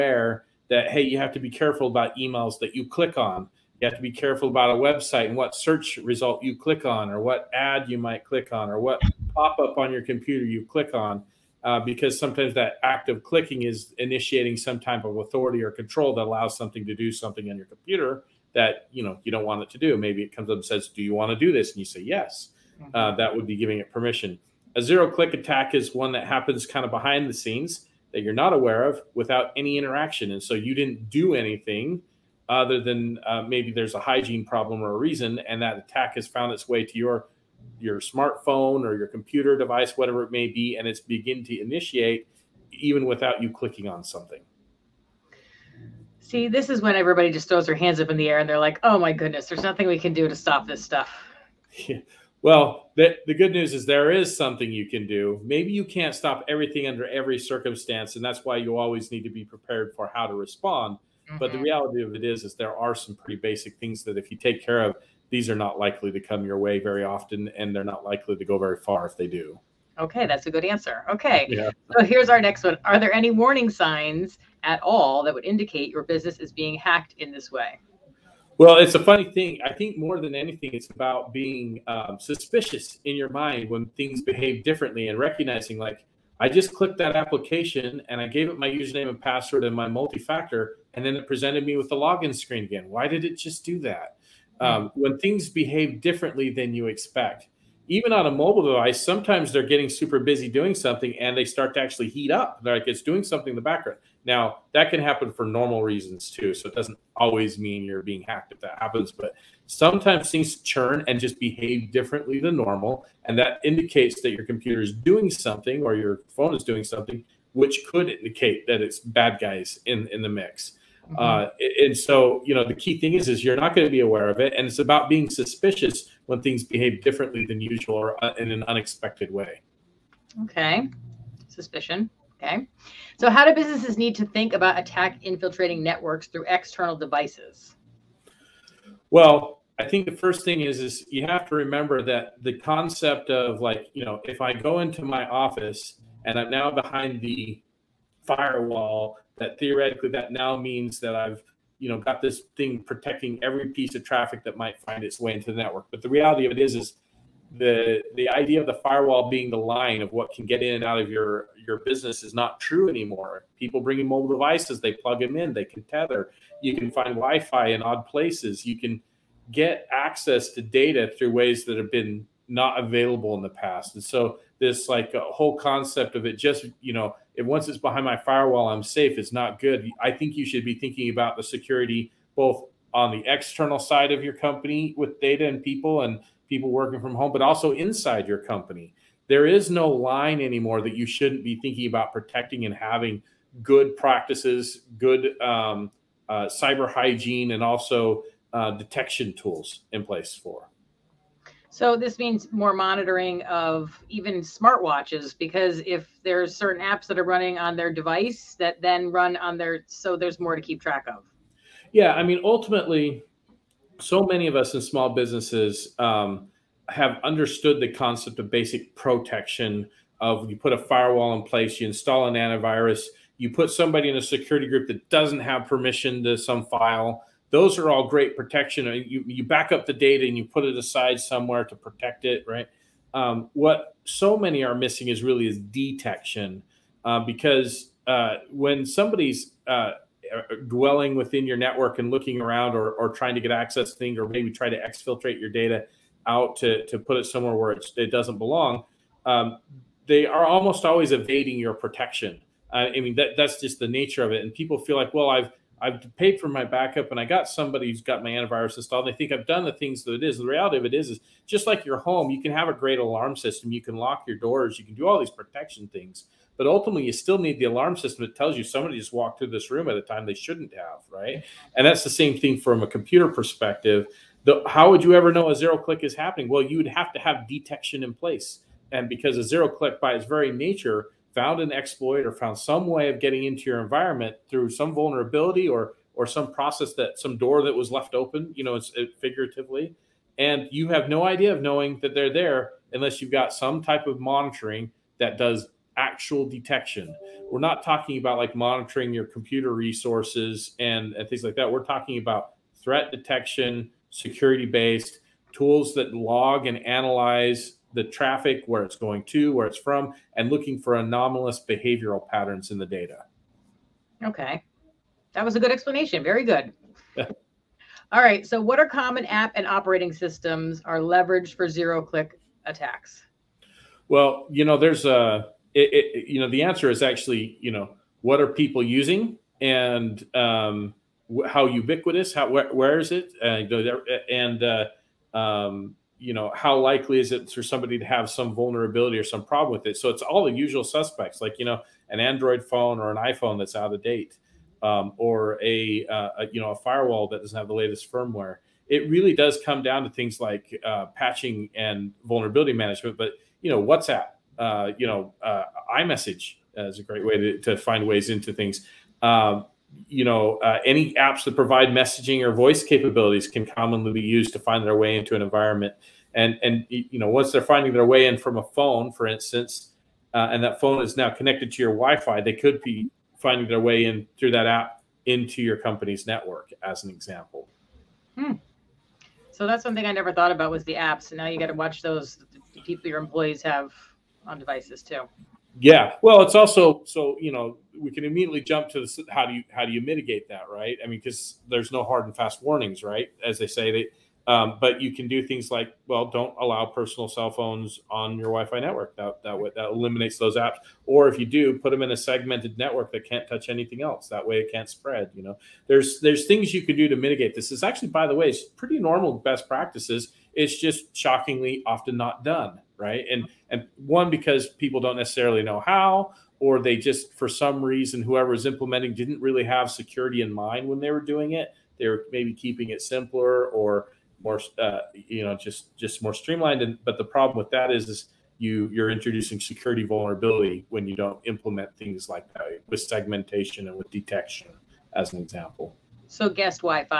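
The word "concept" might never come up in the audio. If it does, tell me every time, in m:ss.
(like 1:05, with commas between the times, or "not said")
2:22, 2:55, 3:37.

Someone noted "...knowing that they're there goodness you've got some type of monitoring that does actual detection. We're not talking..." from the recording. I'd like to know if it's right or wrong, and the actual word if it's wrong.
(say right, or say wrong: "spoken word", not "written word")
wrong: "unless", not "goodness".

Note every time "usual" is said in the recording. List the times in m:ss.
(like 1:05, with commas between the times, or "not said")
2:07, 5:40.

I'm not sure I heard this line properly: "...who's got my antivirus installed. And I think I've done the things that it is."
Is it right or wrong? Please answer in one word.
right.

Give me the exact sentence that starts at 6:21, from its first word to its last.
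And now you got to watch those people your employees have on devices too.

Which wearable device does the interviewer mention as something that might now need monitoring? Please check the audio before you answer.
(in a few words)
Smartwatches.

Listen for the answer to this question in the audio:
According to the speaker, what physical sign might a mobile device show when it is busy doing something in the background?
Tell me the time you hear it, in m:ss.
1:42.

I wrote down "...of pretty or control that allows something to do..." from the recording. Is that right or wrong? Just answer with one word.
wrong.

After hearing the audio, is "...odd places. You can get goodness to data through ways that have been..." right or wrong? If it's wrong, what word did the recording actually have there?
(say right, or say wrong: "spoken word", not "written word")
wrong: "access", not "goodness".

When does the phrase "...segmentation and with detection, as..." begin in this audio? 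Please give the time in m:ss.
7:13.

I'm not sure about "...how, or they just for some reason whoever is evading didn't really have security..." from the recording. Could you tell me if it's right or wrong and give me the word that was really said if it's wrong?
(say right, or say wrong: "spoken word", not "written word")
wrong: "implementing", not "evading".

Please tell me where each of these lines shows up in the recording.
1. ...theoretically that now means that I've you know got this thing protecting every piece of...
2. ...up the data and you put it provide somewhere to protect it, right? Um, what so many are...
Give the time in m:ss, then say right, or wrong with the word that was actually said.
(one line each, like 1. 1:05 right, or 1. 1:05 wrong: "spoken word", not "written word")
1. 2:29 right
2. 3:49 wrong: "aside", not "provide".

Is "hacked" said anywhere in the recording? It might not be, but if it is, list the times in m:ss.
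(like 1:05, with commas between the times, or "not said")
1:16, 1:48.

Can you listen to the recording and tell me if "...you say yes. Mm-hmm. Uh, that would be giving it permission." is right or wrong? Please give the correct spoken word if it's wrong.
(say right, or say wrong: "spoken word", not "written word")
right.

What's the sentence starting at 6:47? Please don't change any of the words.
It's actually, by the way, it's pretty normal best practices.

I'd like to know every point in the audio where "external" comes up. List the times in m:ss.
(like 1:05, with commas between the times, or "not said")
2:16, 3:03.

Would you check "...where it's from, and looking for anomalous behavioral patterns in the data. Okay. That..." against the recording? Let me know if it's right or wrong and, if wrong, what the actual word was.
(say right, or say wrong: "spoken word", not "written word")
right.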